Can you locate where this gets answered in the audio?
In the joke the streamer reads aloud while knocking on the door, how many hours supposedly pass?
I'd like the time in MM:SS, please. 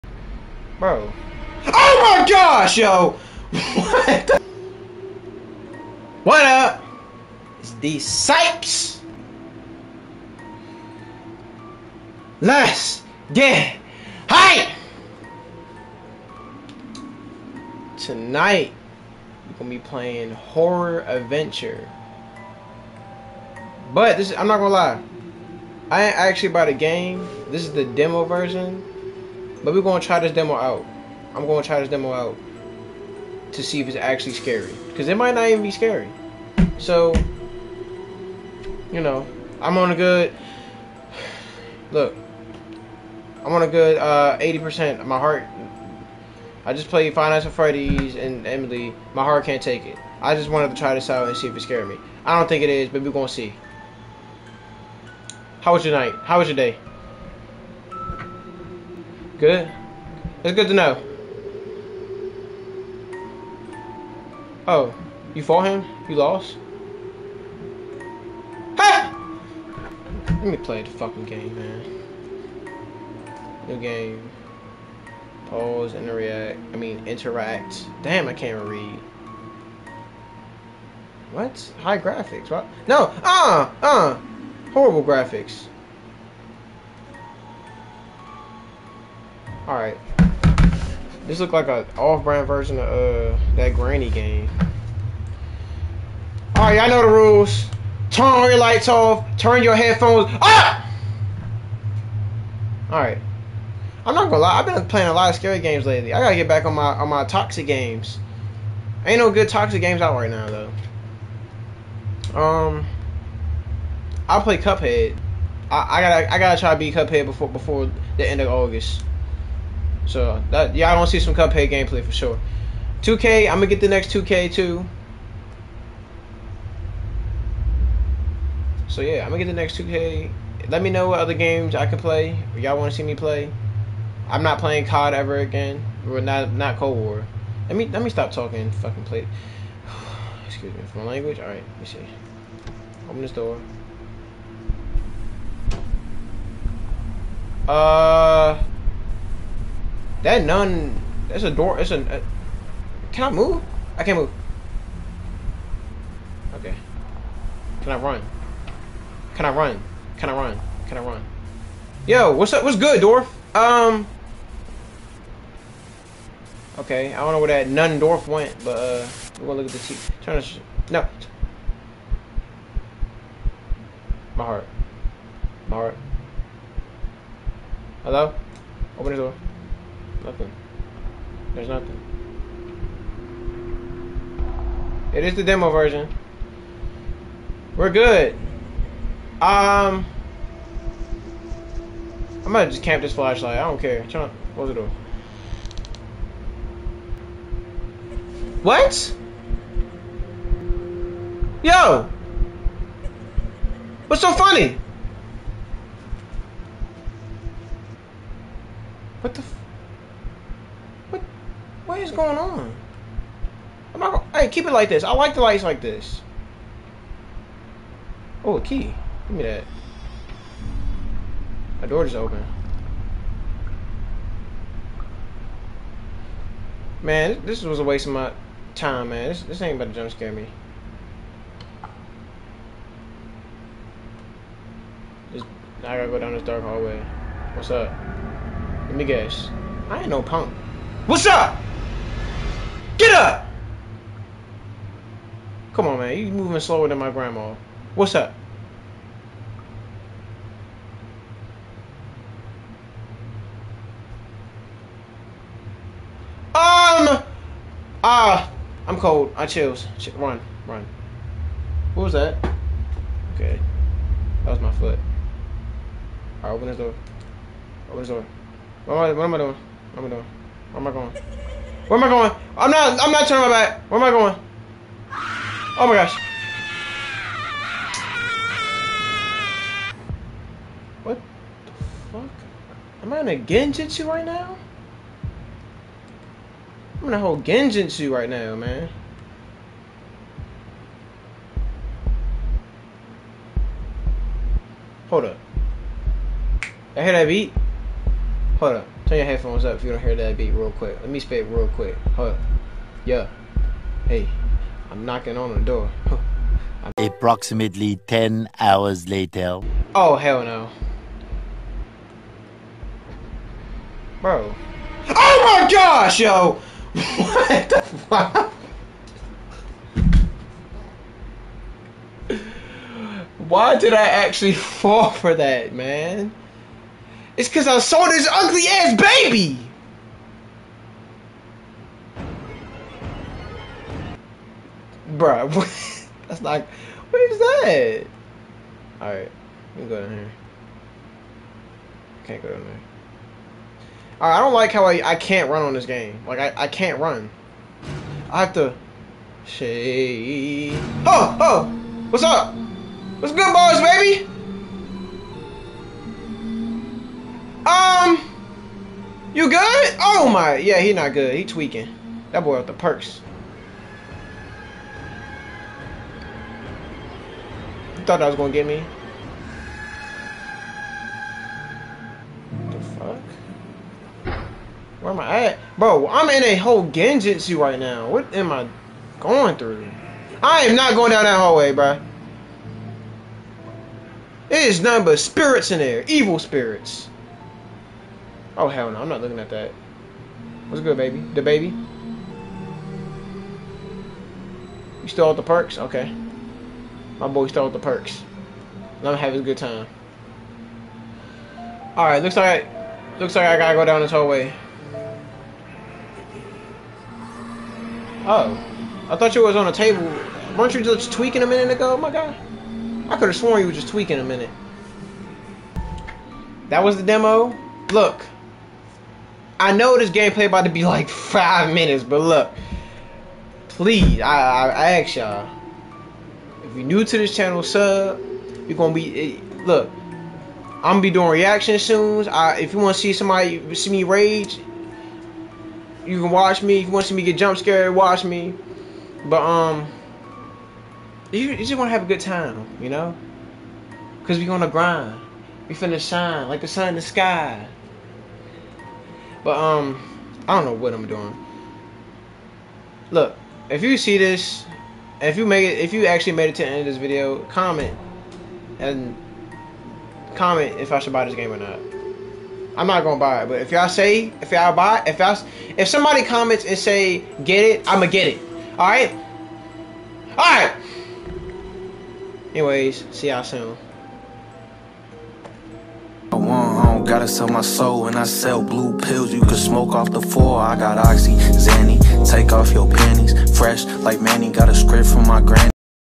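05:08.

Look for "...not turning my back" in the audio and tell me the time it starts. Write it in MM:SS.
04:33.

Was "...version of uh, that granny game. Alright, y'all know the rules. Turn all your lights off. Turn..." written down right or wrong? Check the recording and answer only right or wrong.
right.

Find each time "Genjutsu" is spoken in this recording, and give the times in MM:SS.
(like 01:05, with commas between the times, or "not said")
04:43, 04:47, 06:16.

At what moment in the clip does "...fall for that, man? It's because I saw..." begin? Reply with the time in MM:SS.
05:24.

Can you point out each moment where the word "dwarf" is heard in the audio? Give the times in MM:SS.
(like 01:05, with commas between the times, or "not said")
02:43, 02:47.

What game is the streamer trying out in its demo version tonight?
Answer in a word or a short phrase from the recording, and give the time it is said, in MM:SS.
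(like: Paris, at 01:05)
Horror Adventure, at 00:20.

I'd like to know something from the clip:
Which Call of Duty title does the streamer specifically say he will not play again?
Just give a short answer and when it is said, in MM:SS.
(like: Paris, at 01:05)
Cold War, at 02:16.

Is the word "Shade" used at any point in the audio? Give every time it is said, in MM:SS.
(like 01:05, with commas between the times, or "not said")
05:49.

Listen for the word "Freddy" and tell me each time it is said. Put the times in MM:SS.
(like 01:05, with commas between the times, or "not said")
00:47.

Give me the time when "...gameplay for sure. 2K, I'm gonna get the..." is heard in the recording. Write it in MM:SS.
02:01.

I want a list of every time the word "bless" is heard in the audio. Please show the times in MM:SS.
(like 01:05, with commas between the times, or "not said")
not said.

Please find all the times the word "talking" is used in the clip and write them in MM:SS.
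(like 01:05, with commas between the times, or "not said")
02:18.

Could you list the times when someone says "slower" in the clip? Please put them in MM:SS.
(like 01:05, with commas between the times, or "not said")
04:06.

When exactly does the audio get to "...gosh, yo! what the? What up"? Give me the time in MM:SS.
00:02.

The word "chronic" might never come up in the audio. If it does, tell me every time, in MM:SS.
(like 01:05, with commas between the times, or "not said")
not said.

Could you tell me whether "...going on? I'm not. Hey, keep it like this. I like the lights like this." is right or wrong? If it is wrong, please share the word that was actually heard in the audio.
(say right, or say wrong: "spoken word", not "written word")
right.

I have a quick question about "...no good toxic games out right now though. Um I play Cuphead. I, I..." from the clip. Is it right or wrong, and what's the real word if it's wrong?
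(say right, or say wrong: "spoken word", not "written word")
right.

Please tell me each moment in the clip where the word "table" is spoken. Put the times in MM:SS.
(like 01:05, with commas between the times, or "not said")
06:49.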